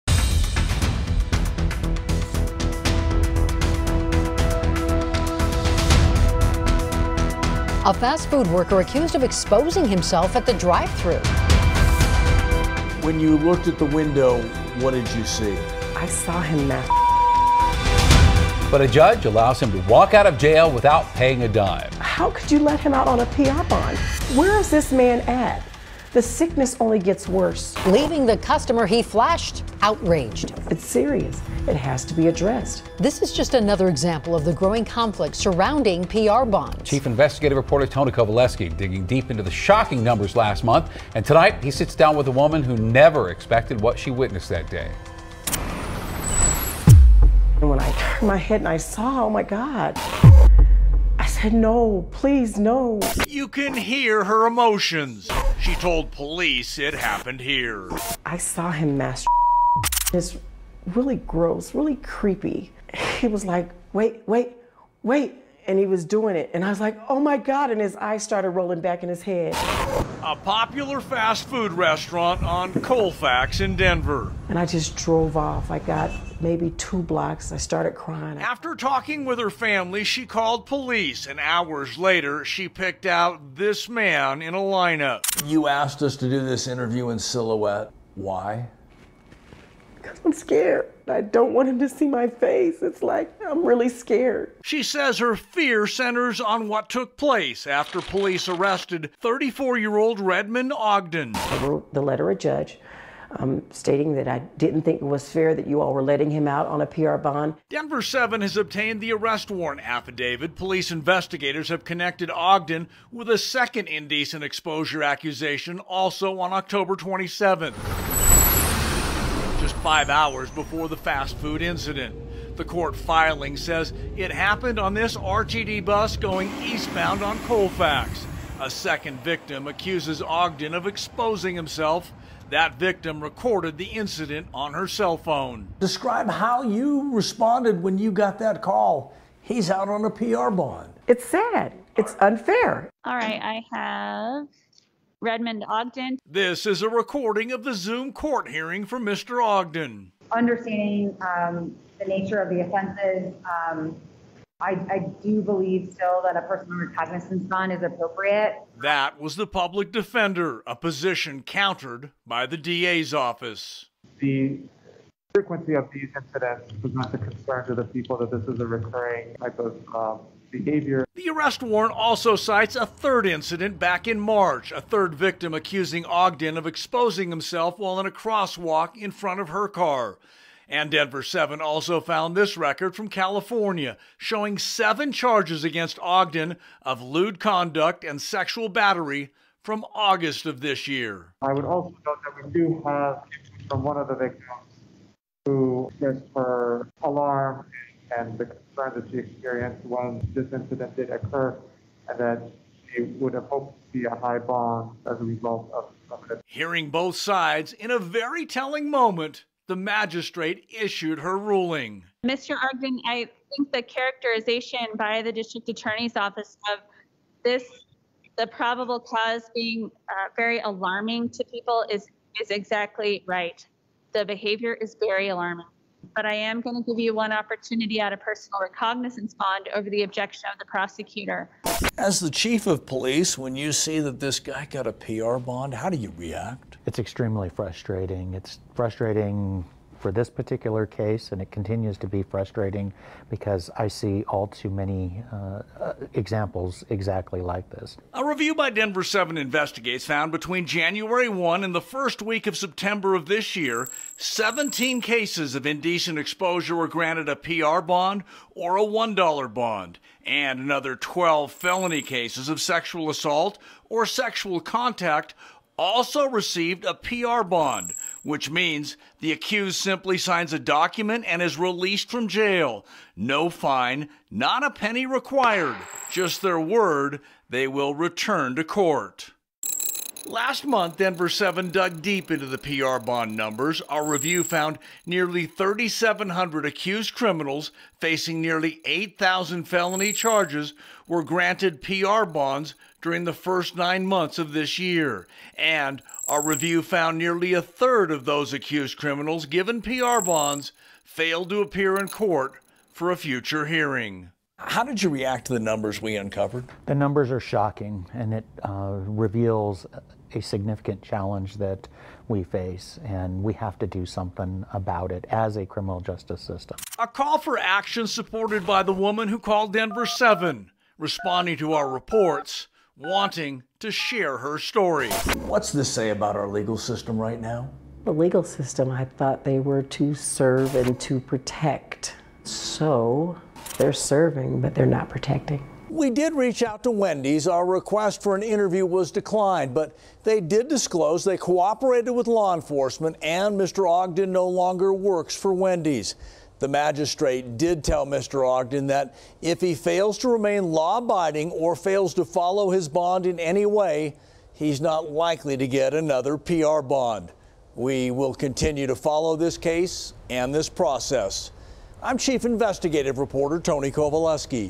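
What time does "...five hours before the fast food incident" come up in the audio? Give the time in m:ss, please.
1:59.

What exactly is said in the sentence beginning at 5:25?
What's this say about our legal system right now?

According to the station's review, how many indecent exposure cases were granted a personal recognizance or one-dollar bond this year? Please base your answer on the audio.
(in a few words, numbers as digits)
17.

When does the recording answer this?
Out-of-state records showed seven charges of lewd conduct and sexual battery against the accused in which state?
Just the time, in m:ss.
3:03.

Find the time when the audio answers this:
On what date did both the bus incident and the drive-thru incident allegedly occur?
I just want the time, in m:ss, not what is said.
1:56.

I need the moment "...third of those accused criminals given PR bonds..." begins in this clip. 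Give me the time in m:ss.
4:57.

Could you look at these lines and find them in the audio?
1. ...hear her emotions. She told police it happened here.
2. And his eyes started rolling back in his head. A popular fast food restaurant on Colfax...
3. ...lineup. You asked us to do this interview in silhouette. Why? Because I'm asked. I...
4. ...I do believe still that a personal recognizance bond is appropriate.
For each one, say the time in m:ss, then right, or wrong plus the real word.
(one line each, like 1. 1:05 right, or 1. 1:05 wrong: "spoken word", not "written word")
1. 0:53 right
2. 1:07 right
3. 1:24 wrong: "scared", not "asked"
4. 2:34 right.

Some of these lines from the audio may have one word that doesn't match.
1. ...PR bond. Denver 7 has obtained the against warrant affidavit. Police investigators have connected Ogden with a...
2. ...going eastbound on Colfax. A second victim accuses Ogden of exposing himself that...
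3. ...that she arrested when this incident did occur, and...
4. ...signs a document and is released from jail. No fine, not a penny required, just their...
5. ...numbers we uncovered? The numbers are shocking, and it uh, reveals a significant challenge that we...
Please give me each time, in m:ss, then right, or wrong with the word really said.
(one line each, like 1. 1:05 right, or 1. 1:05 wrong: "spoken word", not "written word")
1. 1:46 wrong: "arrest", not "against"
2. 2:06 right
3. 3:18 wrong: "experienced", not "arrested"
4. 4:30 right
5. 5:05 right.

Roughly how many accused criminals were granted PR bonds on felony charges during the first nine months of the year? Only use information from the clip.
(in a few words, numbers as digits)
3,700.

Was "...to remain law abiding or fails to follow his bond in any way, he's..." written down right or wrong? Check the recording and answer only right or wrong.
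right.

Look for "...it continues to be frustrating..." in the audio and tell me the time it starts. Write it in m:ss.
4:01.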